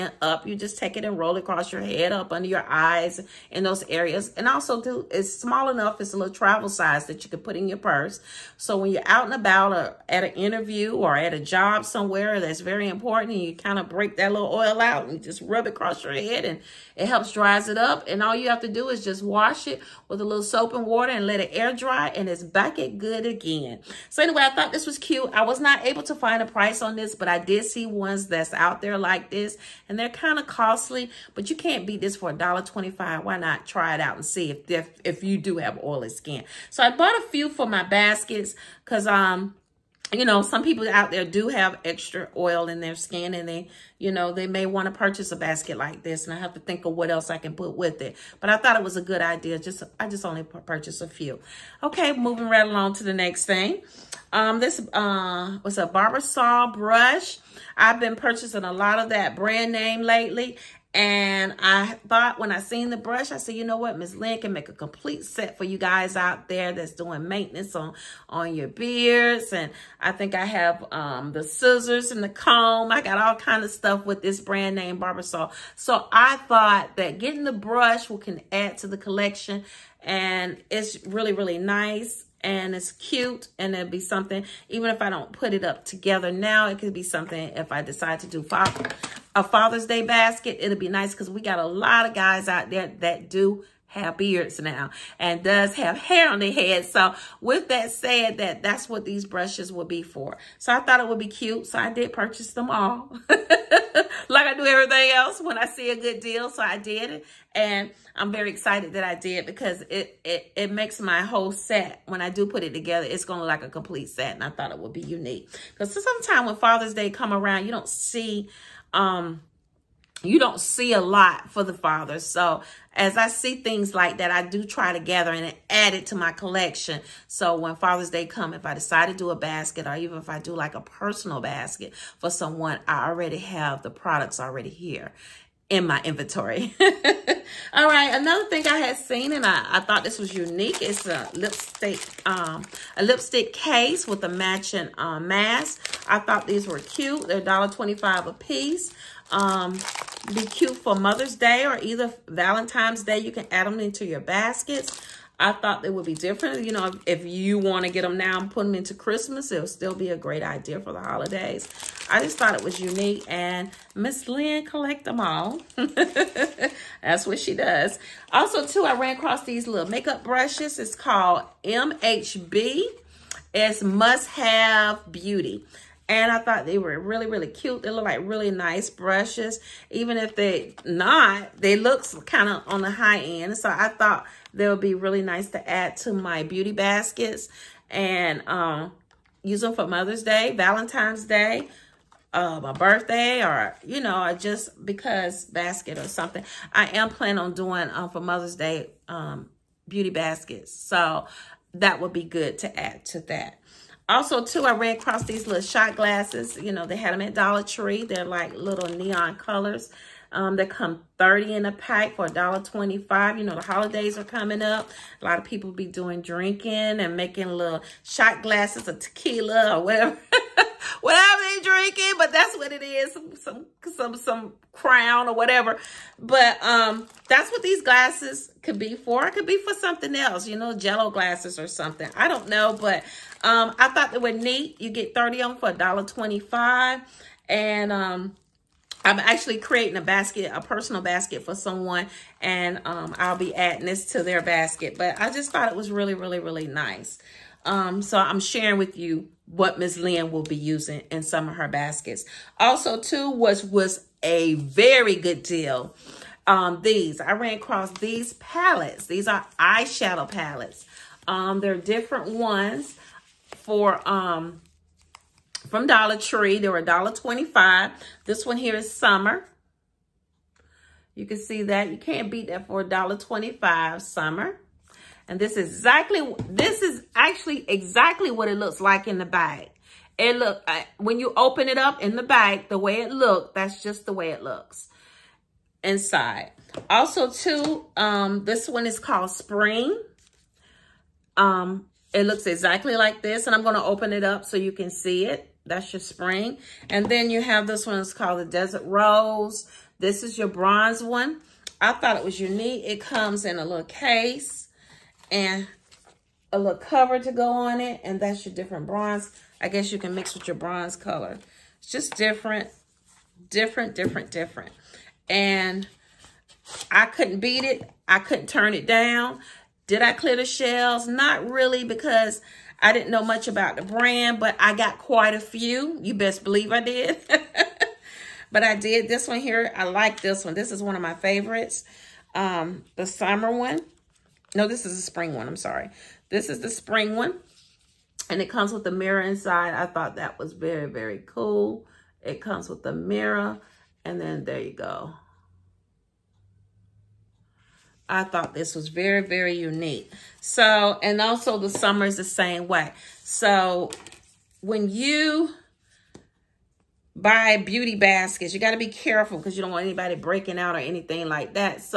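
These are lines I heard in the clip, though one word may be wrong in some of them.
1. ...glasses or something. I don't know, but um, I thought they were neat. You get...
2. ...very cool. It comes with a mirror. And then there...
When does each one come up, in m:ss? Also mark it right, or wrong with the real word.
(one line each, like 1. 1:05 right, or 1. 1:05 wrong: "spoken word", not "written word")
1. 3:51 right
2. 5:40 right.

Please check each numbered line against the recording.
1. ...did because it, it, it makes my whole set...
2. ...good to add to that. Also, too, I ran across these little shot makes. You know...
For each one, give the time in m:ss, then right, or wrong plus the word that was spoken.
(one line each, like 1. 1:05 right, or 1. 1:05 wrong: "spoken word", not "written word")
1. 1:49 right
2. 3:22 wrong: "glasses", not "makes".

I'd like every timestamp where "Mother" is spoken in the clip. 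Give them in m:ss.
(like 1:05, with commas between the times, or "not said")
2:30, 3:09, 3:18.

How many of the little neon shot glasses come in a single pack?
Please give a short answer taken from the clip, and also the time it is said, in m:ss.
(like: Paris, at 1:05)
30, at 3:31.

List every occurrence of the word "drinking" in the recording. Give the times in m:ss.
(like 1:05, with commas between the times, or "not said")
3:36, 3:41.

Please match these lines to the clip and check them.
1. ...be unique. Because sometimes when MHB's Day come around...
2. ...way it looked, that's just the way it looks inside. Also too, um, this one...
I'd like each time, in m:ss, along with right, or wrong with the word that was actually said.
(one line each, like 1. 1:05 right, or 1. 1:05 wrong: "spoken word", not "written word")
1. 1:54 wrong: "Father", not "MHB"
2. 4:42 right.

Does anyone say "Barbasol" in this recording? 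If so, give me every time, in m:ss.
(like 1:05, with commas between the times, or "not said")
0:55, 1:15.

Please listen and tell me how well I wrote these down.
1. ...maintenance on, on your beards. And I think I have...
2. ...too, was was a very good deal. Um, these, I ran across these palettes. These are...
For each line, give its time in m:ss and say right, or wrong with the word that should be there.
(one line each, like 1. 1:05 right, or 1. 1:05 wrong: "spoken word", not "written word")
1. 1:07 right
2. 4:13 right.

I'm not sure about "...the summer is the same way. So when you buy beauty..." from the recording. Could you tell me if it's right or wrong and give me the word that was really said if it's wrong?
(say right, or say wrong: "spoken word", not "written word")
right.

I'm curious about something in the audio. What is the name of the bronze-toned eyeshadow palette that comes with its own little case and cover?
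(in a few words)
Desert Rose.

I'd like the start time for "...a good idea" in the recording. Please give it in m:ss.
0:48.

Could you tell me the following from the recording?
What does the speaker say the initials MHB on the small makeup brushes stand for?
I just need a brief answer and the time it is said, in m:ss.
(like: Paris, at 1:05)
Must Have Beauty, at 2:53.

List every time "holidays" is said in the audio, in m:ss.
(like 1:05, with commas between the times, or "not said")
2:41, 3:33.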